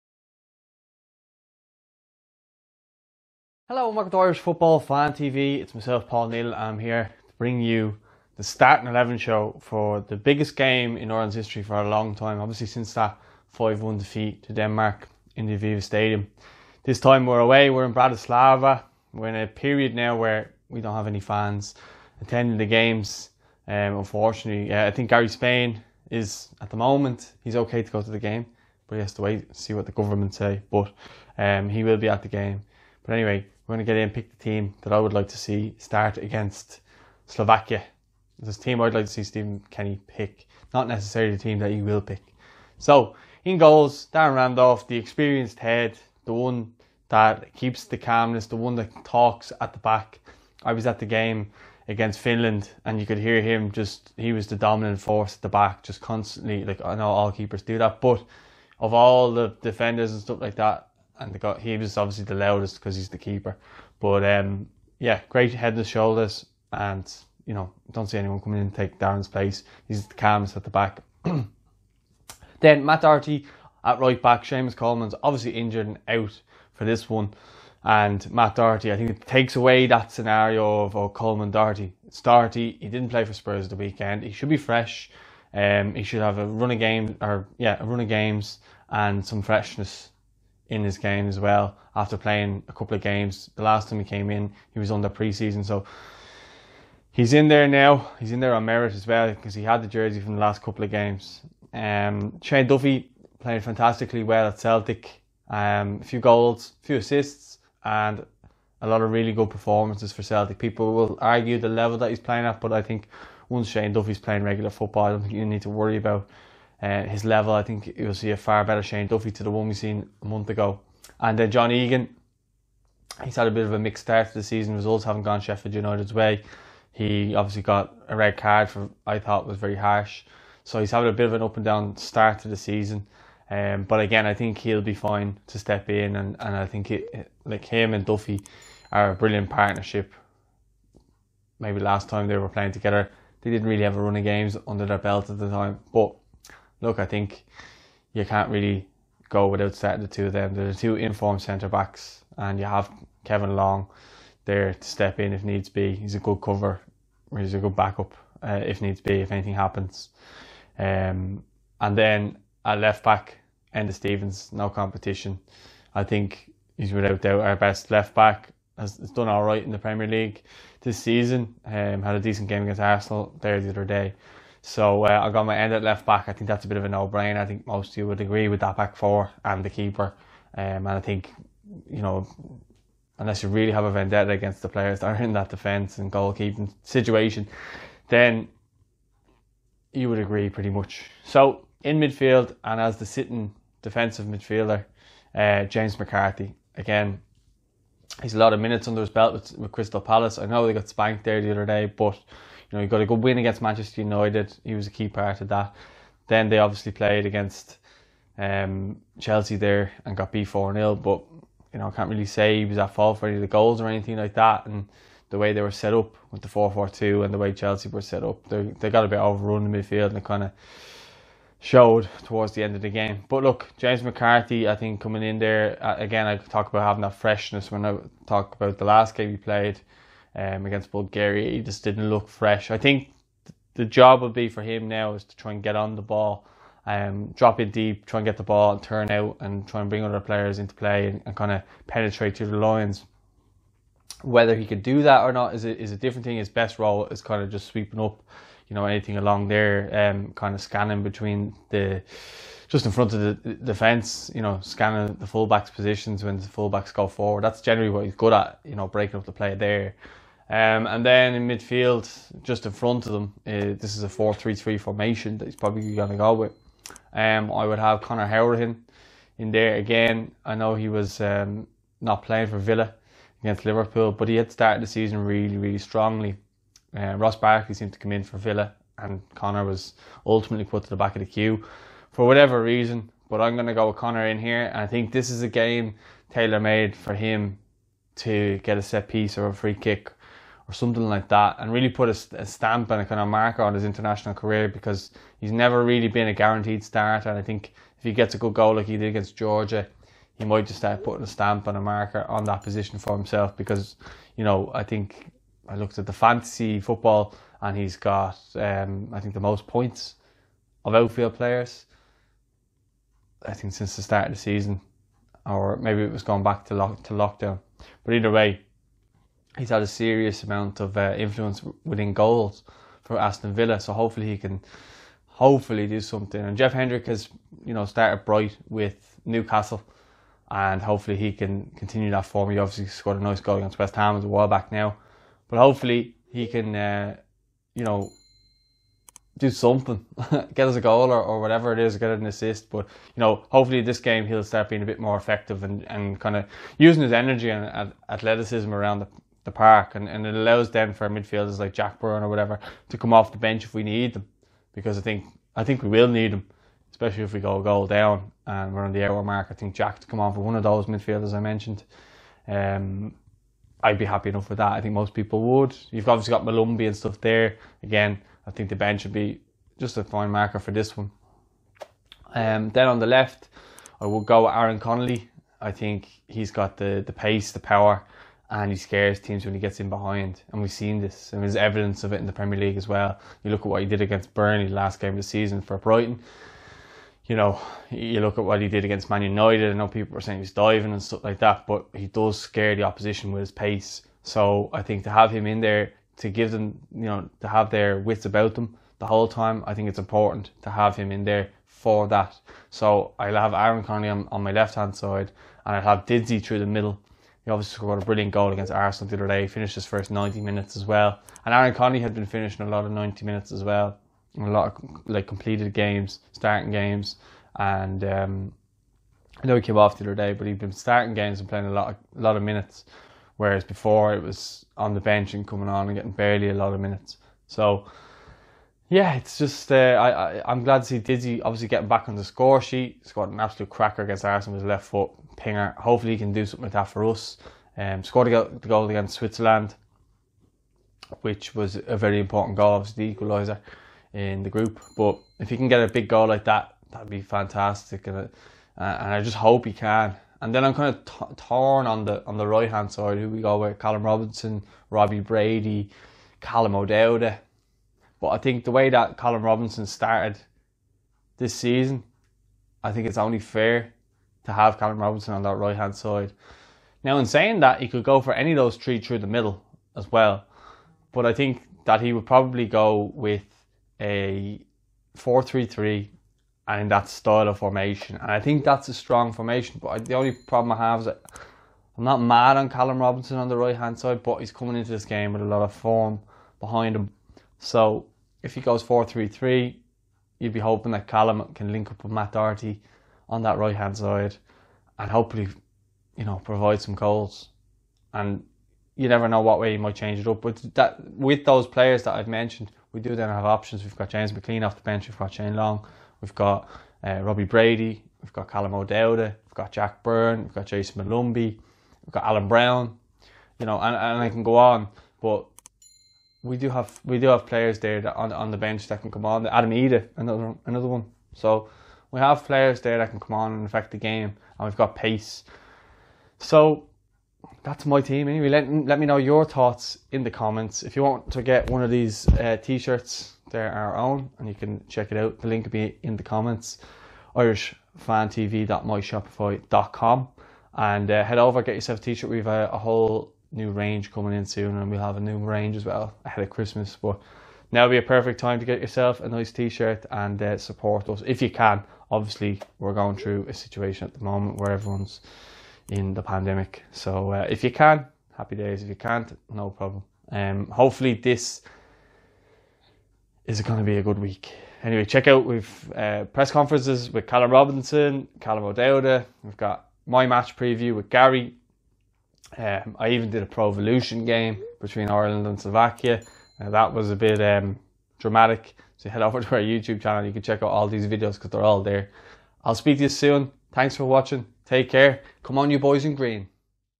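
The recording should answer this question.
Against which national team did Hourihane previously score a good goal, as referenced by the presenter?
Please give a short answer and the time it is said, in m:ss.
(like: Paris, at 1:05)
Georgia, at 4:59.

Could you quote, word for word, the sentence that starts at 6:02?
Um, I'd be happy enough with that.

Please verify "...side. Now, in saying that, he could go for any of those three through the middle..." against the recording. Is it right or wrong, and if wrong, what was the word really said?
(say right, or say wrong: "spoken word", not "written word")
right.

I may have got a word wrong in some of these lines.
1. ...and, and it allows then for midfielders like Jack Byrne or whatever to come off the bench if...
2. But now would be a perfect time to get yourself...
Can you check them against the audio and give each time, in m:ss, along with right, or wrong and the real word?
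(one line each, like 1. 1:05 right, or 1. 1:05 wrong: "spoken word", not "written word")
1. 5:49 right
2. 9:07 right.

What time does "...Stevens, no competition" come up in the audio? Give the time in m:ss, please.
2:43.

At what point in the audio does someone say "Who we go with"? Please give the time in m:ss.
7:33.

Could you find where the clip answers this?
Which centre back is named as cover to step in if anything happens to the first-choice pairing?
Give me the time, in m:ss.
2:33.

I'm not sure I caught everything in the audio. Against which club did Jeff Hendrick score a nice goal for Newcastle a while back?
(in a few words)
West Ham.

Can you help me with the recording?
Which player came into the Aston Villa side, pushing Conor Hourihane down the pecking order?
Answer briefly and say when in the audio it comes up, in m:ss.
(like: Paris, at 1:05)
Ross Barkley, at 4:37.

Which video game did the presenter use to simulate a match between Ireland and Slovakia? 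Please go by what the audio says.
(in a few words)
Pro Evolution.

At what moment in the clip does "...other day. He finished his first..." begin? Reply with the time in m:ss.
6:49.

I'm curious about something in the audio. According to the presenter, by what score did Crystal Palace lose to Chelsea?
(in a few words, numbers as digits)
4-0.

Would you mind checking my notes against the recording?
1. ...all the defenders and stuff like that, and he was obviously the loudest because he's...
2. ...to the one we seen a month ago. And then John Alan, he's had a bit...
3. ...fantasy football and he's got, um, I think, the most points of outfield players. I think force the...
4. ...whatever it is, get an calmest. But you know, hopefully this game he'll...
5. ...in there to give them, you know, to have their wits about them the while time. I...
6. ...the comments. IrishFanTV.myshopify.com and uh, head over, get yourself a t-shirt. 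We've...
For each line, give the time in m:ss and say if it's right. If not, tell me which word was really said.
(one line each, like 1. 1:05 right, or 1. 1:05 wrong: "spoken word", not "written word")
1. 0:58 right
2. 1:59 wrong: "Egan", not "Alan"
3. 5:06 wrong: "since", not "force"
4. 5:41 wrong: "assist", not "calmest"
5. 6:35 wrong: "whole", not "while"
6. 8:56 right.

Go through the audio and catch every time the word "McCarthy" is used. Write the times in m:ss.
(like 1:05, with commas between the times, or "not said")
3:15, 3:44.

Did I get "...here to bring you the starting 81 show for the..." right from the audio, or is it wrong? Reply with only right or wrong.
wrong.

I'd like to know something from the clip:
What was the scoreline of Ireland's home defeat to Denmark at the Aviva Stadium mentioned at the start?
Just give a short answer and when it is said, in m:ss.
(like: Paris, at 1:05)
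5-1, at 0:13.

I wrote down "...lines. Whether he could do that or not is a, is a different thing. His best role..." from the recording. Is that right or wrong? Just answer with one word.
right.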